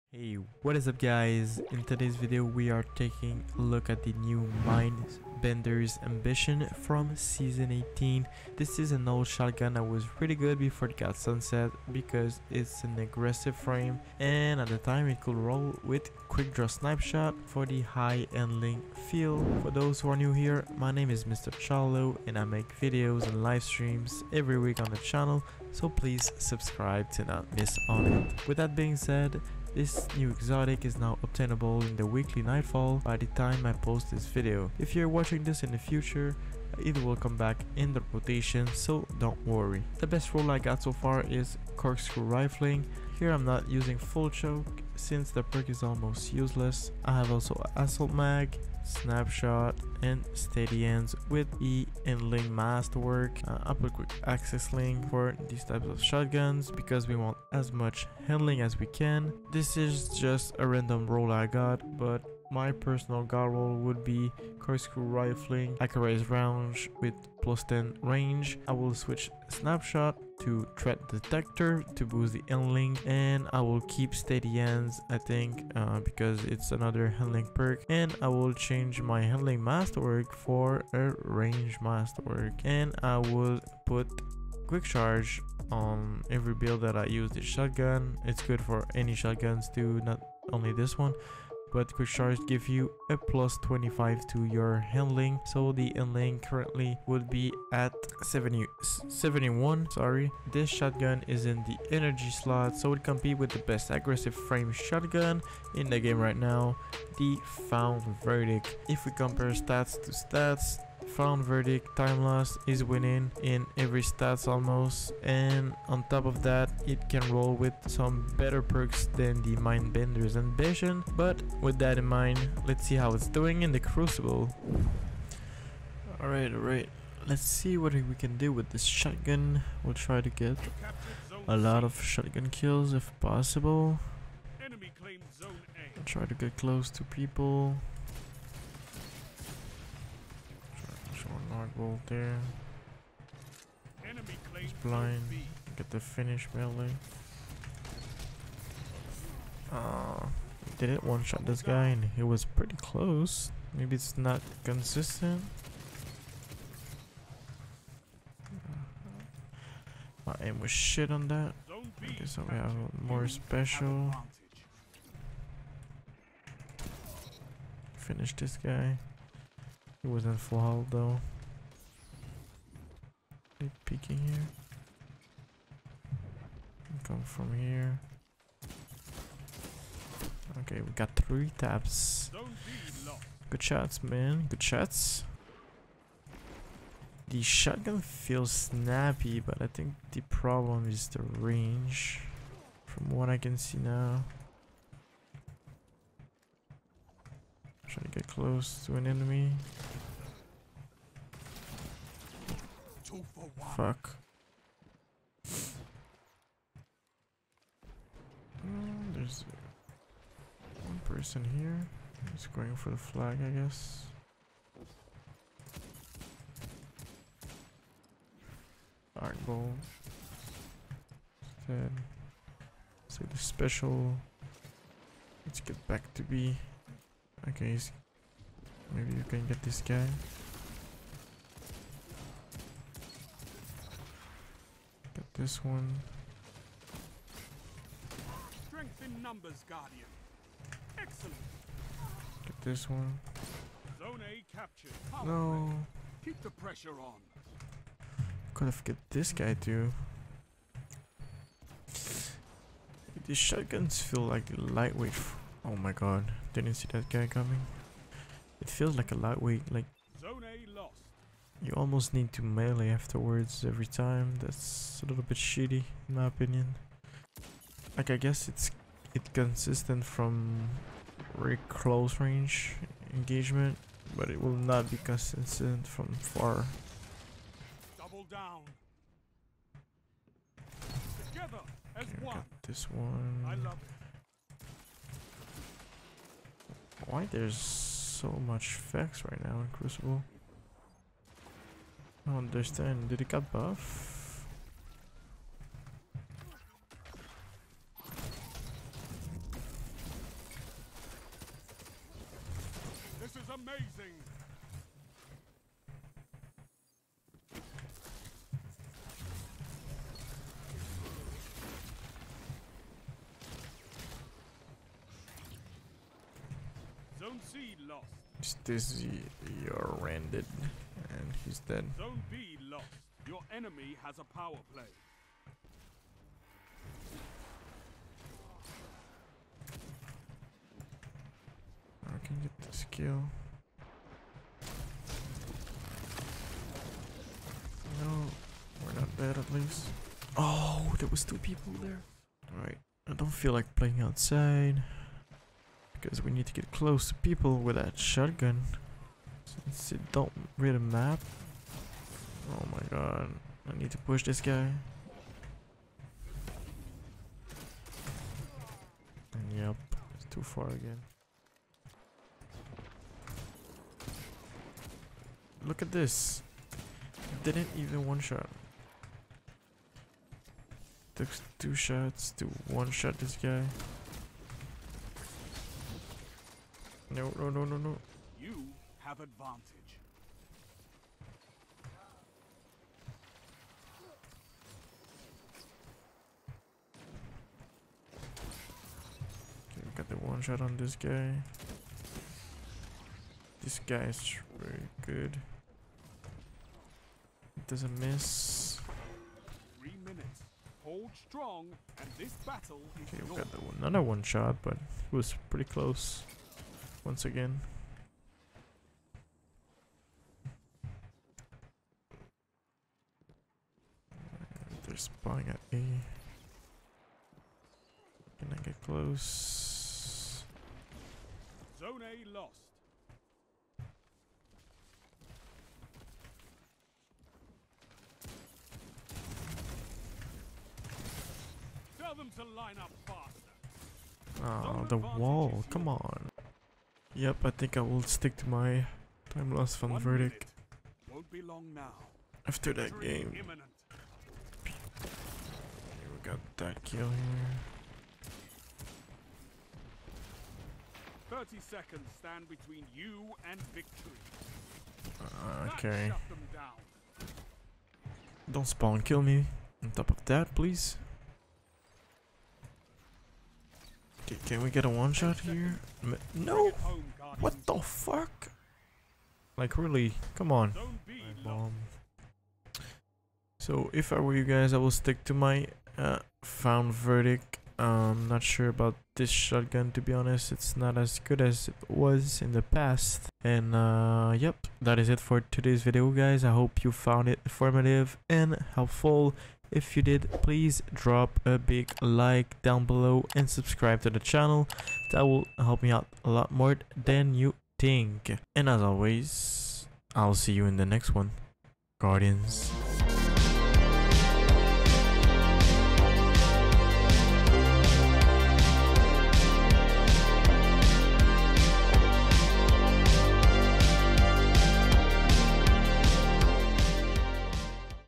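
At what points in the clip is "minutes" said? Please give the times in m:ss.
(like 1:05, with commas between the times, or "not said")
6:40.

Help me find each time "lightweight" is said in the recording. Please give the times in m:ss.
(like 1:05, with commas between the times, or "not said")
4:14, 4:19.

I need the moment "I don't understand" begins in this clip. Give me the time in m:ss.
4:52.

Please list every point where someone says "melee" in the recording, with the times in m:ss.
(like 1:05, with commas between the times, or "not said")
2:26, 4:22.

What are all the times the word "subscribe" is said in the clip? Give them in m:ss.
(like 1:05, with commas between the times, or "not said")
0:26, 8:13.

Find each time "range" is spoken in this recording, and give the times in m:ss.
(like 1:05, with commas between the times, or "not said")
1:08, 1:21, 3:11, 4:32.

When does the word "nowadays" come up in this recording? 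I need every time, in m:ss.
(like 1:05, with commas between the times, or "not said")
not said.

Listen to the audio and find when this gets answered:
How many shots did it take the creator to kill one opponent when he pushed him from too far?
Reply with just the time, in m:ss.
6:11.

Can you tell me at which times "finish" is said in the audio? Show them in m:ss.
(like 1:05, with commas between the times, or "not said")
2:25, 2:47.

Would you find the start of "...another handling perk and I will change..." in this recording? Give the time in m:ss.
1:16.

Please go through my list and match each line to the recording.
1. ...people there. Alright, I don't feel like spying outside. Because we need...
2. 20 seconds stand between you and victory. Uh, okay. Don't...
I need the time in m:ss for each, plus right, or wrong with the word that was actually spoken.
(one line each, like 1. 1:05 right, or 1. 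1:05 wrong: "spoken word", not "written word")
1. 5:41 wrong: "playing", not "spying"
2. 7:31 wrong: "30", not "20".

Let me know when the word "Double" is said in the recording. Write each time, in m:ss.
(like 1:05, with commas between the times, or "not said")
4:37.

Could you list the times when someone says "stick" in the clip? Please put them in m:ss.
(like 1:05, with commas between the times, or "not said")
7:18, 7:54.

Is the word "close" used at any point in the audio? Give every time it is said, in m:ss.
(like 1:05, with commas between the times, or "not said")
2:16, 2:32, 3:18, 4:31, 5:46, 6:45, 6:58.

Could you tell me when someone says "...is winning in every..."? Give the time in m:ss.
1:52.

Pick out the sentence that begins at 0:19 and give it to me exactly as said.
For those who are new here, my name is Mr.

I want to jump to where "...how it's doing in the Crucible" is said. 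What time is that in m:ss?
2:02.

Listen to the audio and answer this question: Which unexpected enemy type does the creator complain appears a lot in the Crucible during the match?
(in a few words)
Vex.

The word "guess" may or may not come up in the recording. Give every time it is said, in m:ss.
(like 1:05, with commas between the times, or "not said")
3:33, 4:28.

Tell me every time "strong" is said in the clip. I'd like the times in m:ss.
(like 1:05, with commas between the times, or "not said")
6:41.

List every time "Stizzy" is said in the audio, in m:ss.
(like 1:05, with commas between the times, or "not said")
5:18.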